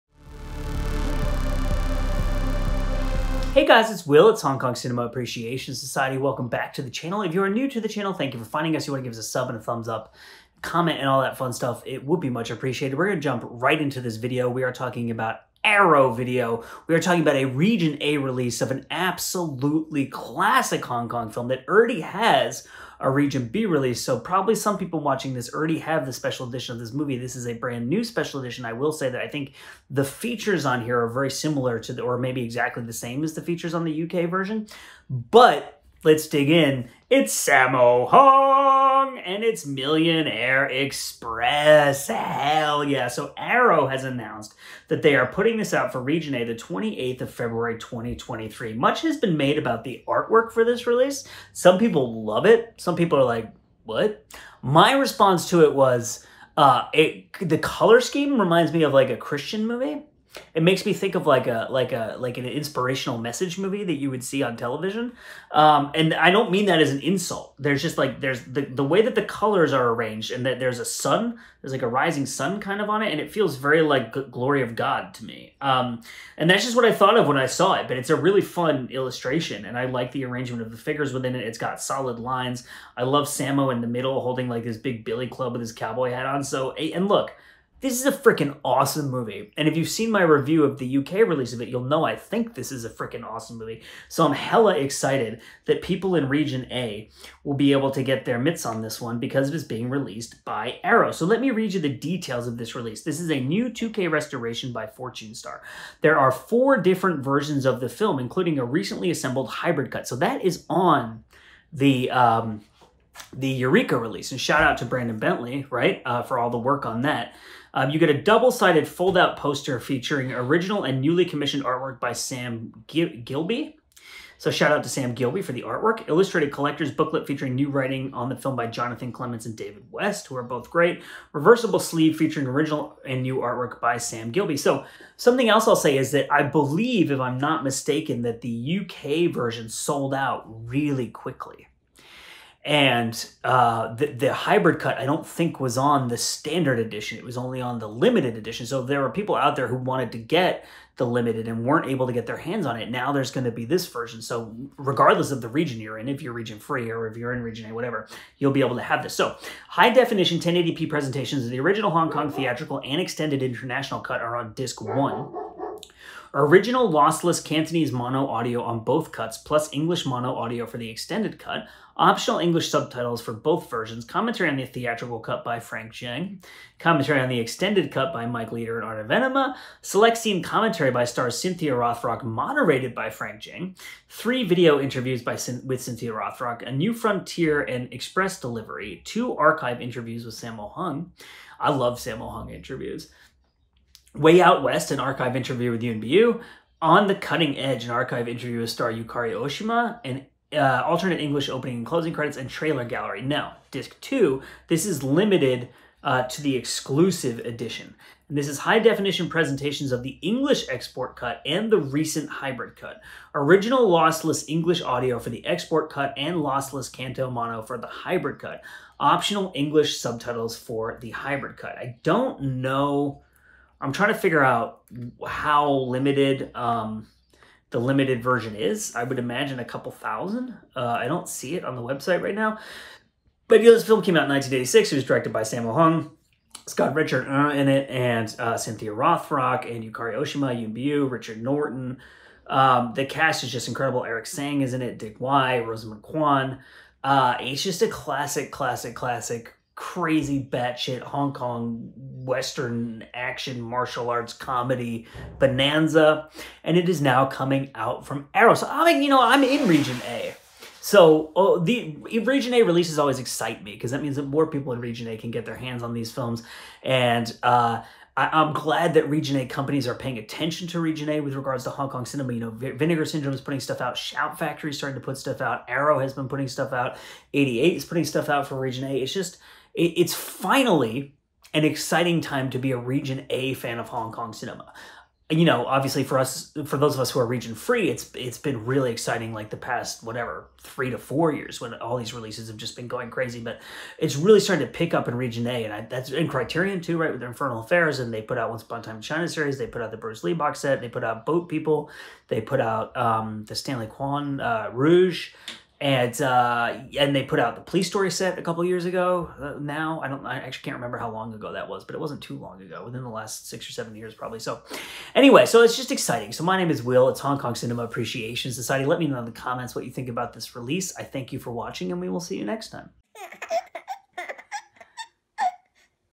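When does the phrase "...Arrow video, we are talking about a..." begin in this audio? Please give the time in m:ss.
0:15.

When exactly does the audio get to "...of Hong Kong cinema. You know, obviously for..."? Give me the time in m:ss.
4:43.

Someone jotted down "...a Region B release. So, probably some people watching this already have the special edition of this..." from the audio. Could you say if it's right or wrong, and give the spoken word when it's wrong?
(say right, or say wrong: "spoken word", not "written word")
right.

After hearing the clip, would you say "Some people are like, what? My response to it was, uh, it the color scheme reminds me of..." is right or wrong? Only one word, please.
right.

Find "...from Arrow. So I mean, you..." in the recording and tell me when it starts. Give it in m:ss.
4:18.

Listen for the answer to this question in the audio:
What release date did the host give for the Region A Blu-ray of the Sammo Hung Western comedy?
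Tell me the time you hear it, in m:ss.
0:46.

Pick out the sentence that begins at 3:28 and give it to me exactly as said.
And this is high definition presentations of the English export cut and the recent hybrid cut.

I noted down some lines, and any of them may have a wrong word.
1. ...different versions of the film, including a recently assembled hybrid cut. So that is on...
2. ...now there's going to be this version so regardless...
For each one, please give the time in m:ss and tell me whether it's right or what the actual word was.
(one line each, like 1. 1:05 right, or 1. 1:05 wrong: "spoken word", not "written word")
1. 1:46 right
2. 2:32 right.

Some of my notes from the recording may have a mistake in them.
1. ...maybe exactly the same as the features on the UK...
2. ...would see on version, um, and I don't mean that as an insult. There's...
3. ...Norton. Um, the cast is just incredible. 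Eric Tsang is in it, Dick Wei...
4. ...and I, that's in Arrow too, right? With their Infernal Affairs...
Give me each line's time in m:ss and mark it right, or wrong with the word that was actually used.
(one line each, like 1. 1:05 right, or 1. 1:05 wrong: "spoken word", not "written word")
1. 0:32 right
2. 1:04 wrong: "television", not "version"
3. 4:01 right
4. 4:55 wrong: "Criterion", not "Arrow".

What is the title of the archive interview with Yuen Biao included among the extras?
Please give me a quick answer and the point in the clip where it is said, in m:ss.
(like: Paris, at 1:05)
Way Out West, at 3:14.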